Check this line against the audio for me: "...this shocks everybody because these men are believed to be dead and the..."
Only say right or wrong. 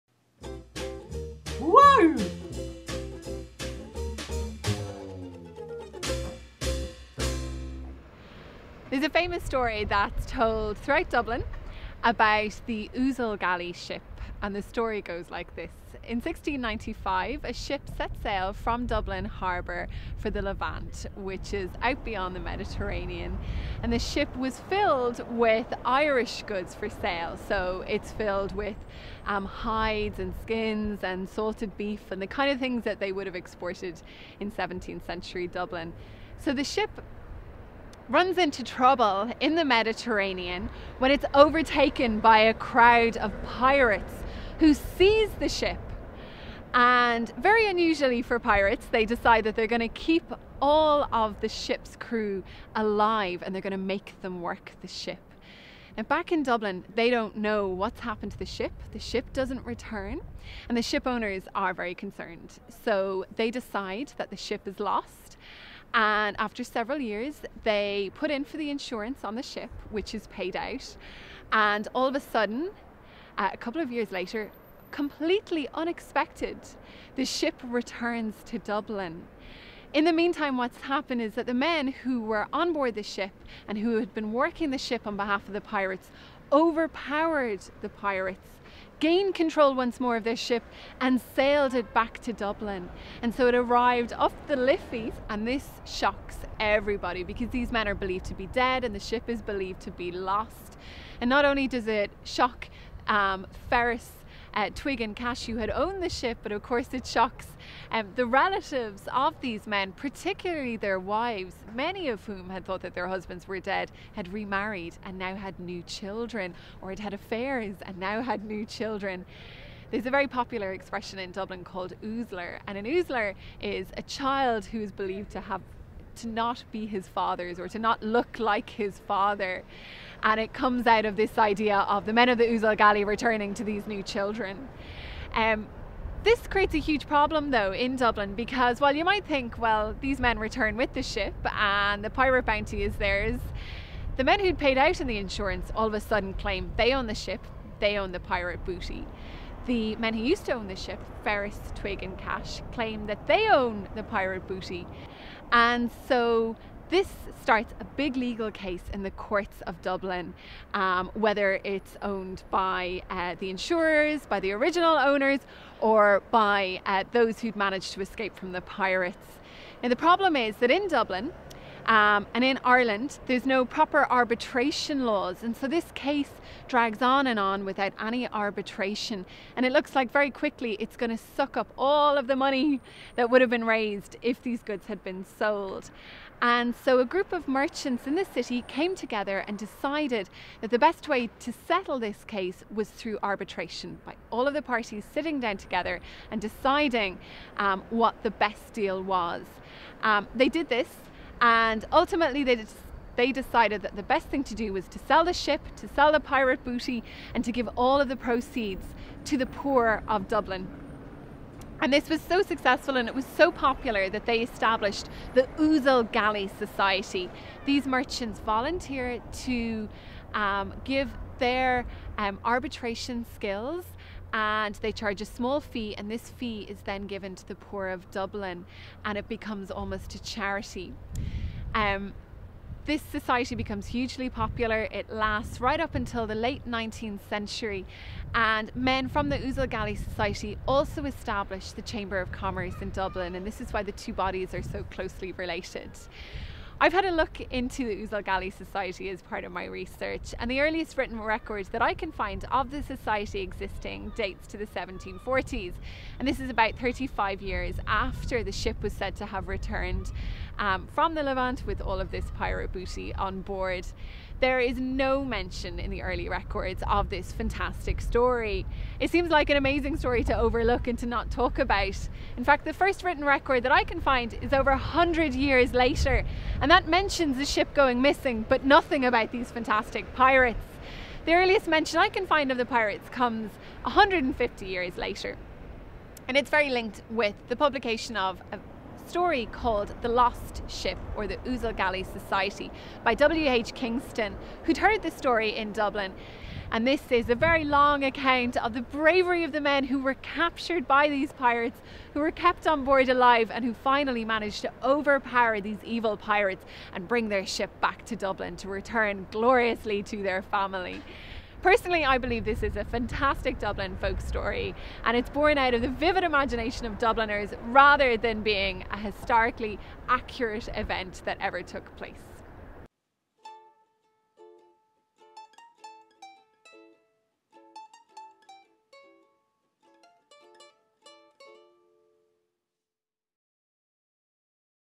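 right.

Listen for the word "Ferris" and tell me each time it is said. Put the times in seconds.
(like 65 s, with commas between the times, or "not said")
103 s, 151 s.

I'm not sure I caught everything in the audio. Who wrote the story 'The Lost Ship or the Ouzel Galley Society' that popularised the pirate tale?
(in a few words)
W.H. Kingston.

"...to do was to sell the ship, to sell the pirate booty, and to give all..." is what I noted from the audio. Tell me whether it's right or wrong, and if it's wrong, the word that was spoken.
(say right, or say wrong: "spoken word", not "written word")
right.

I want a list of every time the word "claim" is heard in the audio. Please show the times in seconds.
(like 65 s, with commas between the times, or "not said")
146 s, 152 s.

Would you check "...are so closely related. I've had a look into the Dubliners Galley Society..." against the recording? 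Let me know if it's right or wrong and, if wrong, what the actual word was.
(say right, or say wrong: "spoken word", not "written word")
wrong: "Ouzel", not "Dubliners".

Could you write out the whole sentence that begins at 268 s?
It seems like an amazing story to overlook and to not talk about.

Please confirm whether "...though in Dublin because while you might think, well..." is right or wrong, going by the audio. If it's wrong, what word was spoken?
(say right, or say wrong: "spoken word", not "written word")
right.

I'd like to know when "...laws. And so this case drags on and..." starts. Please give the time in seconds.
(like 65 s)
175 s.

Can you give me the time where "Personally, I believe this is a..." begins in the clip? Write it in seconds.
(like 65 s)
311 s.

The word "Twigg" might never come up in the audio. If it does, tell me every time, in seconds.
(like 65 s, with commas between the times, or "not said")
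104 s, 151 s.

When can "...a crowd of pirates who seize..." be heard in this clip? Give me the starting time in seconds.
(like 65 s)
42 s.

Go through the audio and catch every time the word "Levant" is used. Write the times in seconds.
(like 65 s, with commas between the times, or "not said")
20 s, 261 s.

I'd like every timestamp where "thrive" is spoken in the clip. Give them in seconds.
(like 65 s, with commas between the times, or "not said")
not said.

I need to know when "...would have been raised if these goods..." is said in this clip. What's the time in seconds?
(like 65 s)
183 s.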